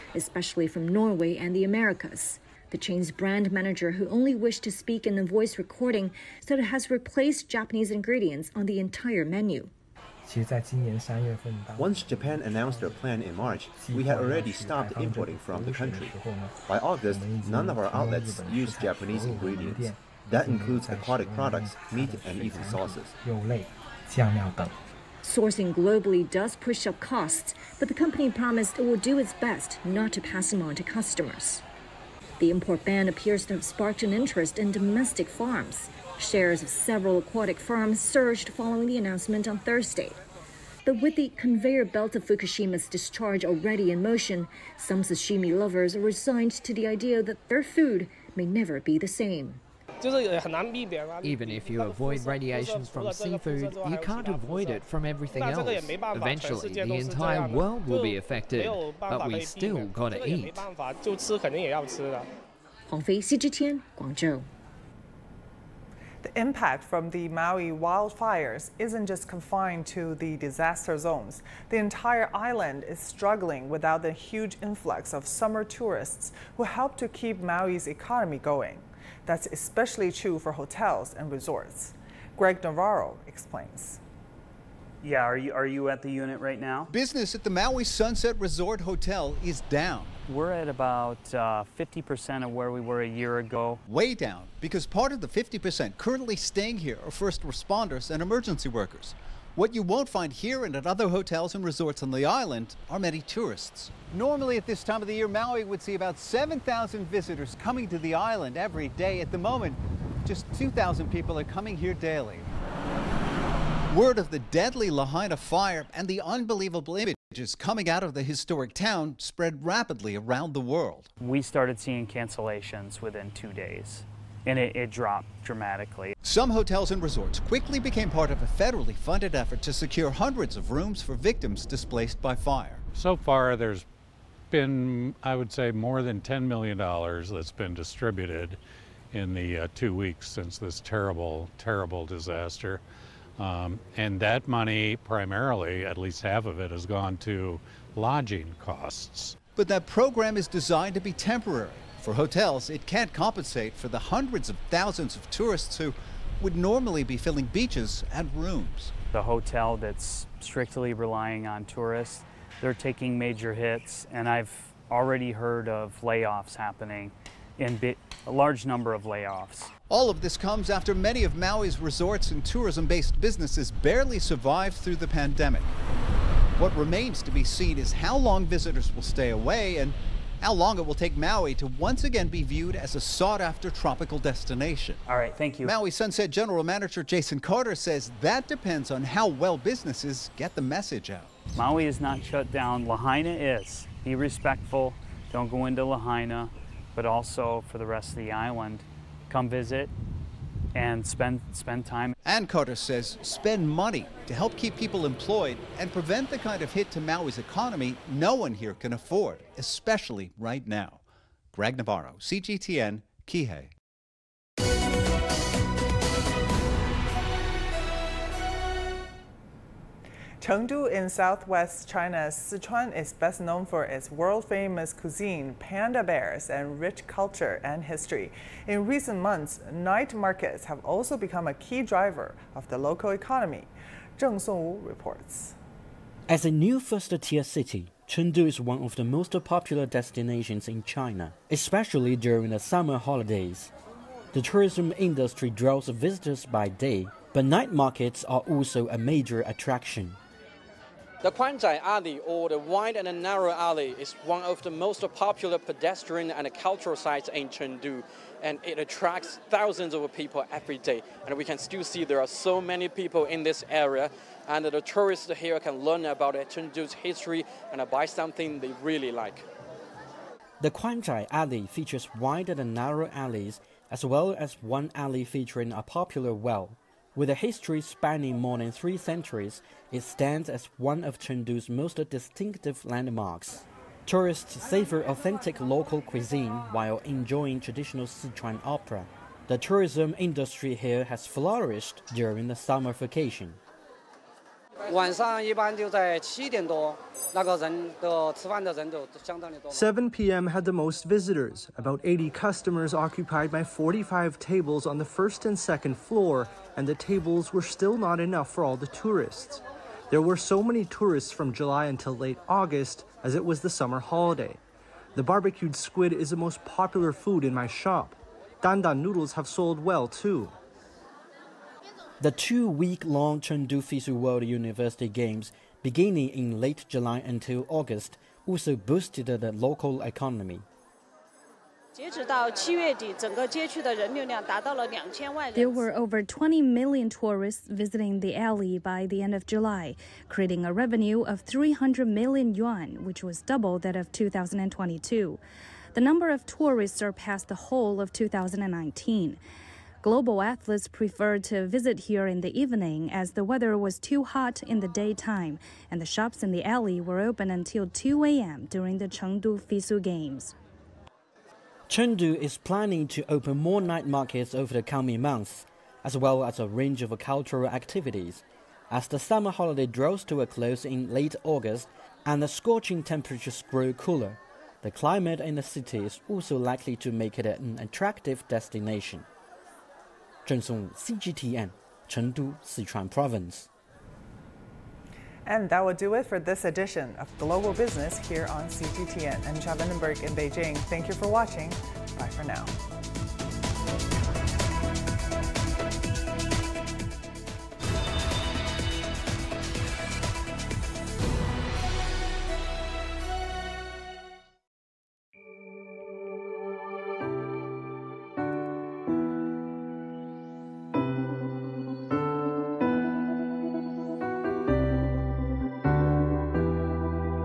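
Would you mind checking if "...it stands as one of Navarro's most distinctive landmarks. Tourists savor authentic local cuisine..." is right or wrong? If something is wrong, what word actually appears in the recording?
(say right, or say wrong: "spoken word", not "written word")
wrong: "Chengdu", not "Navarro".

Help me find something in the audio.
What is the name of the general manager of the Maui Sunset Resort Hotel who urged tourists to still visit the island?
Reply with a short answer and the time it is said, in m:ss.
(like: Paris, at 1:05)
Jason Carter, at 3:07.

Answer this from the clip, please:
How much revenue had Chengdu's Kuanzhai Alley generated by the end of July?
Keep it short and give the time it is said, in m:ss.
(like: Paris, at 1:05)
300 million yuan, at 5:41.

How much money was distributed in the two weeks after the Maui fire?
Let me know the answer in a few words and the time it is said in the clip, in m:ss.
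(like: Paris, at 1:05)
More than $10 million, at 2:15.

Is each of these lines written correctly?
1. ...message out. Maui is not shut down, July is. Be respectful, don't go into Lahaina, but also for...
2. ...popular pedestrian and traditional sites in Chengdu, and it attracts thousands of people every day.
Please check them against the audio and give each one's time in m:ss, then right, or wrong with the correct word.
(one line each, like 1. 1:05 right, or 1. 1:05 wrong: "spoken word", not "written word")
1. 3:10 wrong: "Lahaina", not "July"
2. 4:15 wrong: "cultural", not "traditional".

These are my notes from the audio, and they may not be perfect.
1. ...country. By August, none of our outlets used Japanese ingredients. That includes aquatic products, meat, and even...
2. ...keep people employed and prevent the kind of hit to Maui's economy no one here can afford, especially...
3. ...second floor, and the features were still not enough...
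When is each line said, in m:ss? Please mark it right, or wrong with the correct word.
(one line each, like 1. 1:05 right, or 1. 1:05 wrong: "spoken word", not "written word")
1. 0:15 right
2. 3:24 right
3. 5:05 wrong: "tables", not "features".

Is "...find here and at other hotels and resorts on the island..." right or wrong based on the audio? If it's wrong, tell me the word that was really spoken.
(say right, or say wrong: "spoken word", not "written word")
right.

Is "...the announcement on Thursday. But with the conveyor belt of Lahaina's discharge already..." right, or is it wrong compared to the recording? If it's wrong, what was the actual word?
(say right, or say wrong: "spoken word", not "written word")
wrong: "Fukushima", not "Lahaina".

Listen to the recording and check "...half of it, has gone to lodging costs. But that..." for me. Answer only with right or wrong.
right.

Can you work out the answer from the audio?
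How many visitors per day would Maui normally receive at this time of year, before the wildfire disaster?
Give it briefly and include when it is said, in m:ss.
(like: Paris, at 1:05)
7,000, at 1:46.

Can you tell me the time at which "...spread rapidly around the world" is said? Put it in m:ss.
1:59.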